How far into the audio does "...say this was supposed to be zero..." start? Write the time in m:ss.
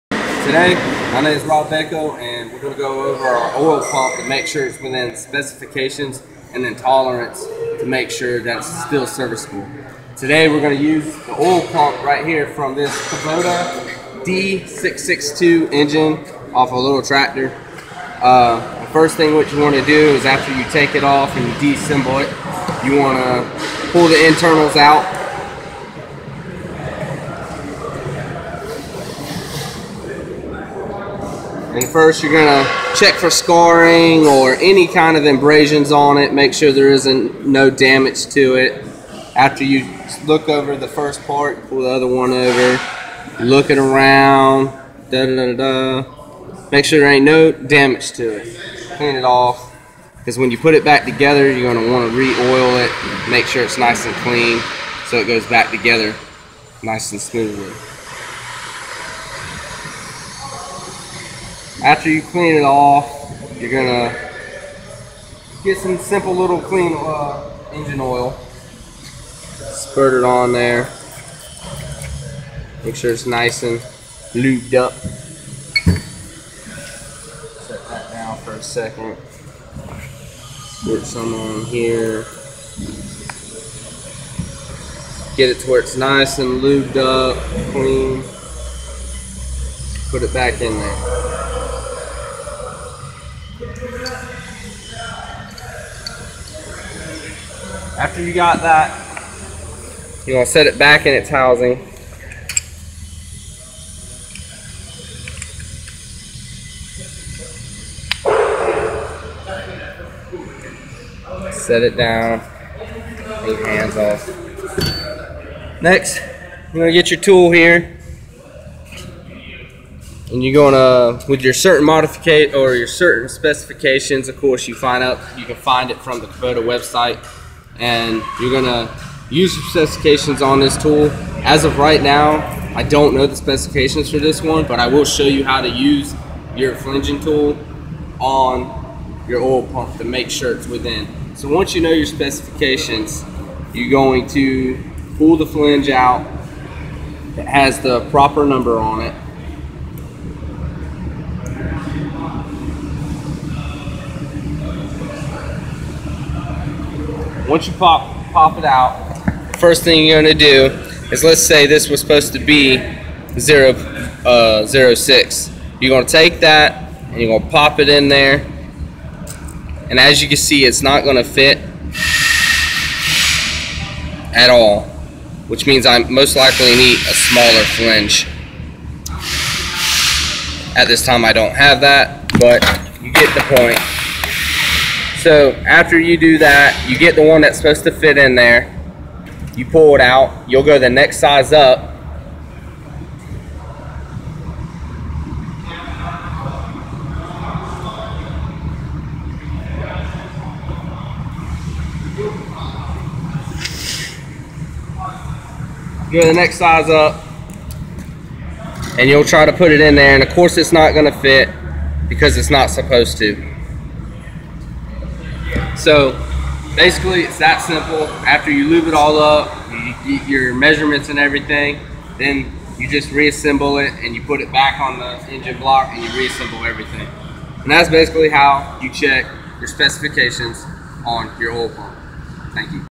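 2:41.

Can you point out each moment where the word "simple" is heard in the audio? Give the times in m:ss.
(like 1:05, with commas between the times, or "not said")
1:05, 3:37.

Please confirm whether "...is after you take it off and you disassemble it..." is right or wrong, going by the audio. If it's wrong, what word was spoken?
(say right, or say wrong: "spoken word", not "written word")
right.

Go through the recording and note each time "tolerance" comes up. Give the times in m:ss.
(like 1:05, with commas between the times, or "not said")
0:06.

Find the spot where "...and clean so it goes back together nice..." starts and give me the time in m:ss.
0:54.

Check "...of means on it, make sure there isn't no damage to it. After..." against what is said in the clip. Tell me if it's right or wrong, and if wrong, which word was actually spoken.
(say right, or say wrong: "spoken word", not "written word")
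wrong: "abrasions", not "means".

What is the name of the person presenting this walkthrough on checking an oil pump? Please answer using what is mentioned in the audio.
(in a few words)
Rob Bako.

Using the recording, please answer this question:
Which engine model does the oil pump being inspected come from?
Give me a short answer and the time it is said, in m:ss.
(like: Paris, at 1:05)
Kubota D662, at 0:13.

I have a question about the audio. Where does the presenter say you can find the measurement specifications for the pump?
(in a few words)
The Kubota website.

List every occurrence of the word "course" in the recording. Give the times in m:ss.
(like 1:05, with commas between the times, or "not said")
2:04, 3:30.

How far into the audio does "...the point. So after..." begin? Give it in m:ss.
3:03.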